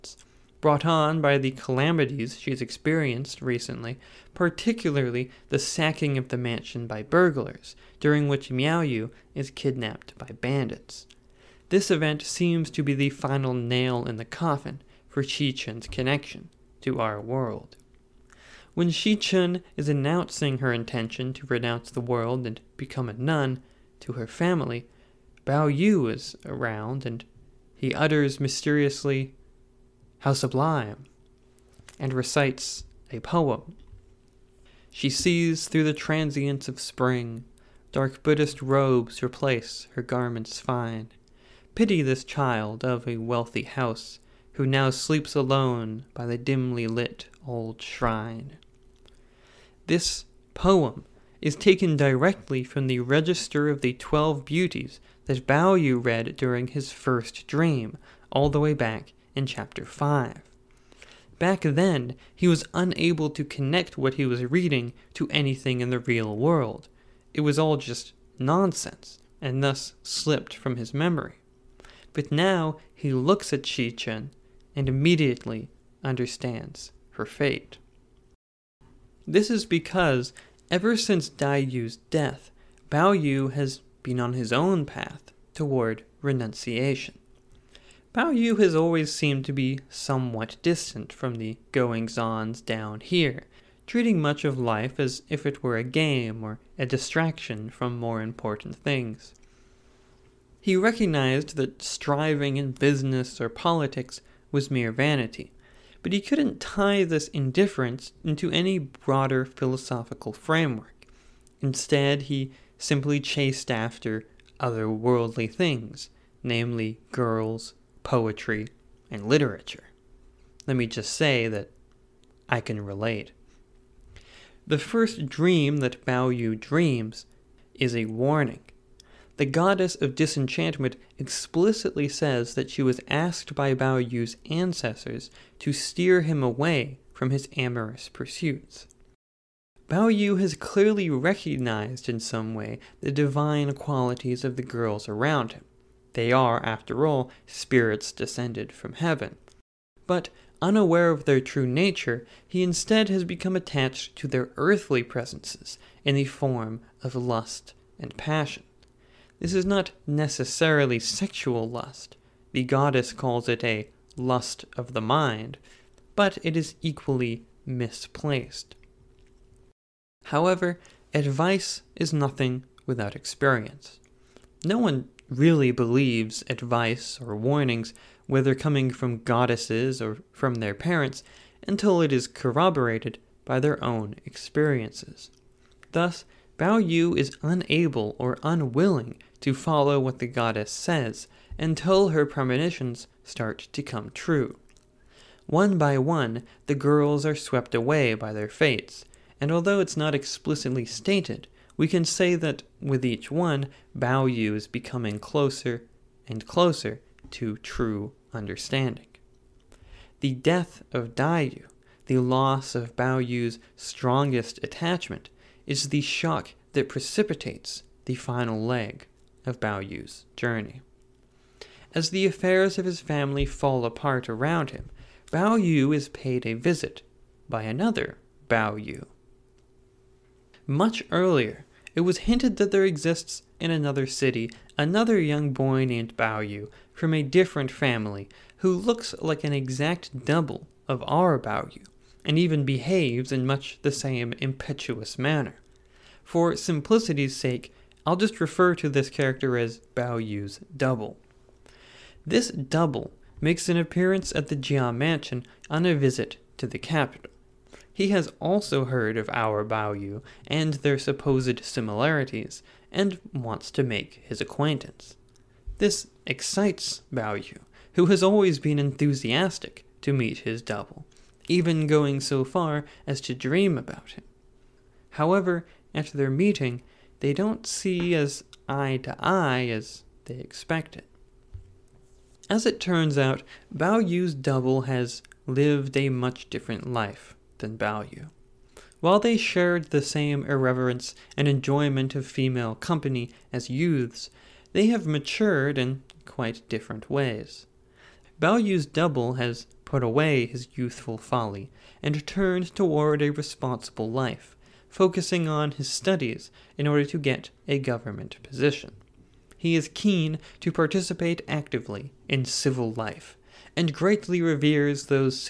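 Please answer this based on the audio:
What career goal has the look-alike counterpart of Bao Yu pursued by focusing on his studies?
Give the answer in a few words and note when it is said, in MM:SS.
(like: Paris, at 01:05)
A government position, at 05:07.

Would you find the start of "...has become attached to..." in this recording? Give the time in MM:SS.
02:33.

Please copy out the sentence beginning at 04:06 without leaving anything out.
For simplicity's sake, I'll just refer to this character as Bao Yu's double.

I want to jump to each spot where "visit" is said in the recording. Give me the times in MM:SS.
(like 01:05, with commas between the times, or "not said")
03:46, 04:15.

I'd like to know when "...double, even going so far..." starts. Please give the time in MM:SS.
04:30.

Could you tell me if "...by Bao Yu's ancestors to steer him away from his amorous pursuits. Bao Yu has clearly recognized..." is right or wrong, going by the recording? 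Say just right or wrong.
right.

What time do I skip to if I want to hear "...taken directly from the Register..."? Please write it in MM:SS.
00:51.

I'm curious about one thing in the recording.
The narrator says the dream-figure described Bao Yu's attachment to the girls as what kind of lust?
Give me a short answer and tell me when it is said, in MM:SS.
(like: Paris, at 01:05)
A lust of the mind, at 02:44.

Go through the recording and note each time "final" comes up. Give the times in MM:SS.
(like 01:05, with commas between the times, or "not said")
00:13, 03:38.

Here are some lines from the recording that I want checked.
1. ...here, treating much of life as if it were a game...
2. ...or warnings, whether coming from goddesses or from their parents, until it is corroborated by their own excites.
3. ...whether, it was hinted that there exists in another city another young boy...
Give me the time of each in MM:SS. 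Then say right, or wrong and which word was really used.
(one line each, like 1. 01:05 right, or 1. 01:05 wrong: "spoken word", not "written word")
1. 01:32 right
2. 02:57 wrong: "experiences", not "excites"
3. 03:51 wrong: "earlier", not "whether".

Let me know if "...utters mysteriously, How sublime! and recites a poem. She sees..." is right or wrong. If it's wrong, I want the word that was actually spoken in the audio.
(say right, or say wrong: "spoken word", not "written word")
right.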